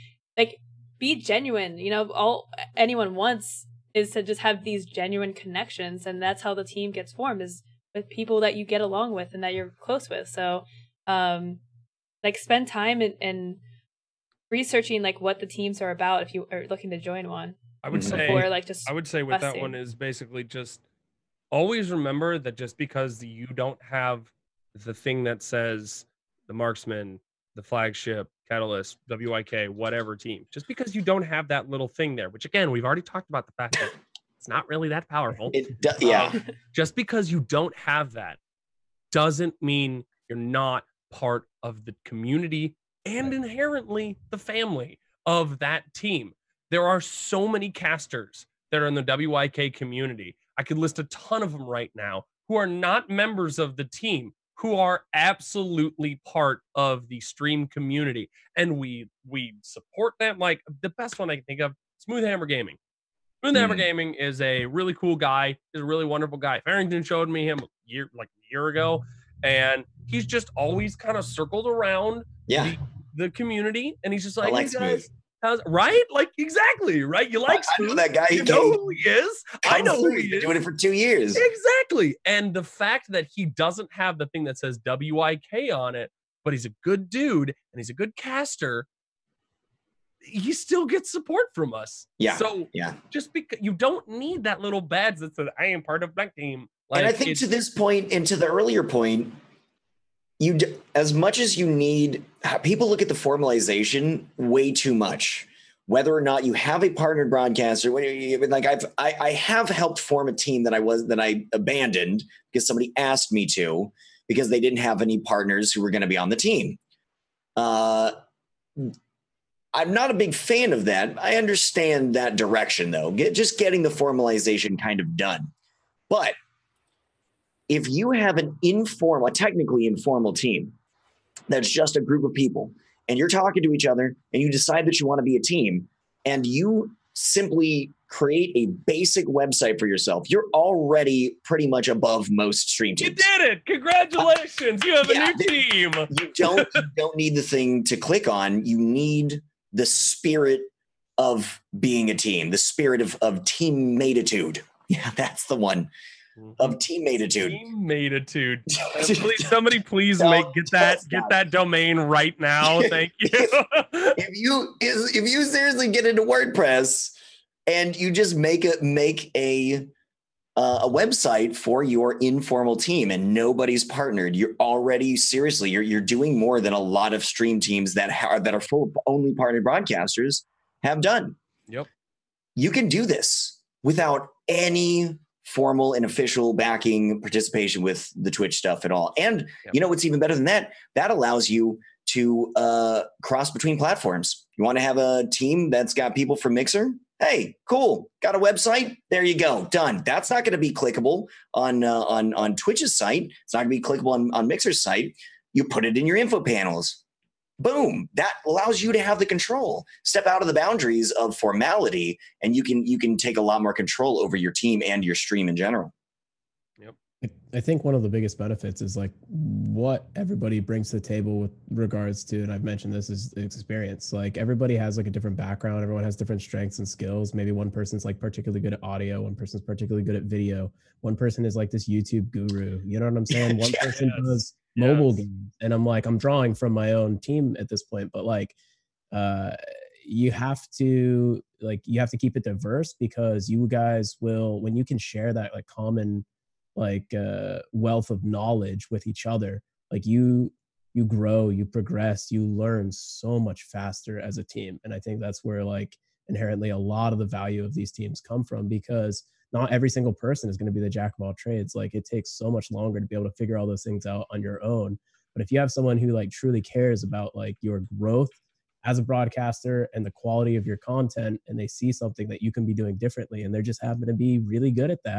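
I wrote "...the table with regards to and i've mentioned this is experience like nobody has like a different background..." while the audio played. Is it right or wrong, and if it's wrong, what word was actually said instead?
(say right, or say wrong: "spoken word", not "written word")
wrong: "everybody", not "nobody".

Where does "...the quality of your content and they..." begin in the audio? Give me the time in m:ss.
4:30.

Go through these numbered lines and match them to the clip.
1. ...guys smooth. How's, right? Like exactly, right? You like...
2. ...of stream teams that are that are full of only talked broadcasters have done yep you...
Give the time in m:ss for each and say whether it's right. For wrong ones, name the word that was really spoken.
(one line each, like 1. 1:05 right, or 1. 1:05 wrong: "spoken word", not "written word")
1. 1:14 right
2. 2:57 wrong: "partnered", not "talked".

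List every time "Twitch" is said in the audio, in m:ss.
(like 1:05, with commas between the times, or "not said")
3:08, 3:22.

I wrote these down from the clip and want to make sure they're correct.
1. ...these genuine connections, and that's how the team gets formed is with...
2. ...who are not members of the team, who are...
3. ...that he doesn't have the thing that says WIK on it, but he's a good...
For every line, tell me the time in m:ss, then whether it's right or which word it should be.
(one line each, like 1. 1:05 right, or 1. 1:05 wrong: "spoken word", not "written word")
1. 0:04 right
2. 0:52 right
3. 1:23 right.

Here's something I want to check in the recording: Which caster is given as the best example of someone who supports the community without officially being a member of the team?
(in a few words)
Smooth Hammer Gaming.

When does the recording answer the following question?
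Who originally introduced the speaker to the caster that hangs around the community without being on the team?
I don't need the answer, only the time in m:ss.
1:06.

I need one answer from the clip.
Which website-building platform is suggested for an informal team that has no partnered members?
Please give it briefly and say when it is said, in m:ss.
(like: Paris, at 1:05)
WordPress, at 2:46.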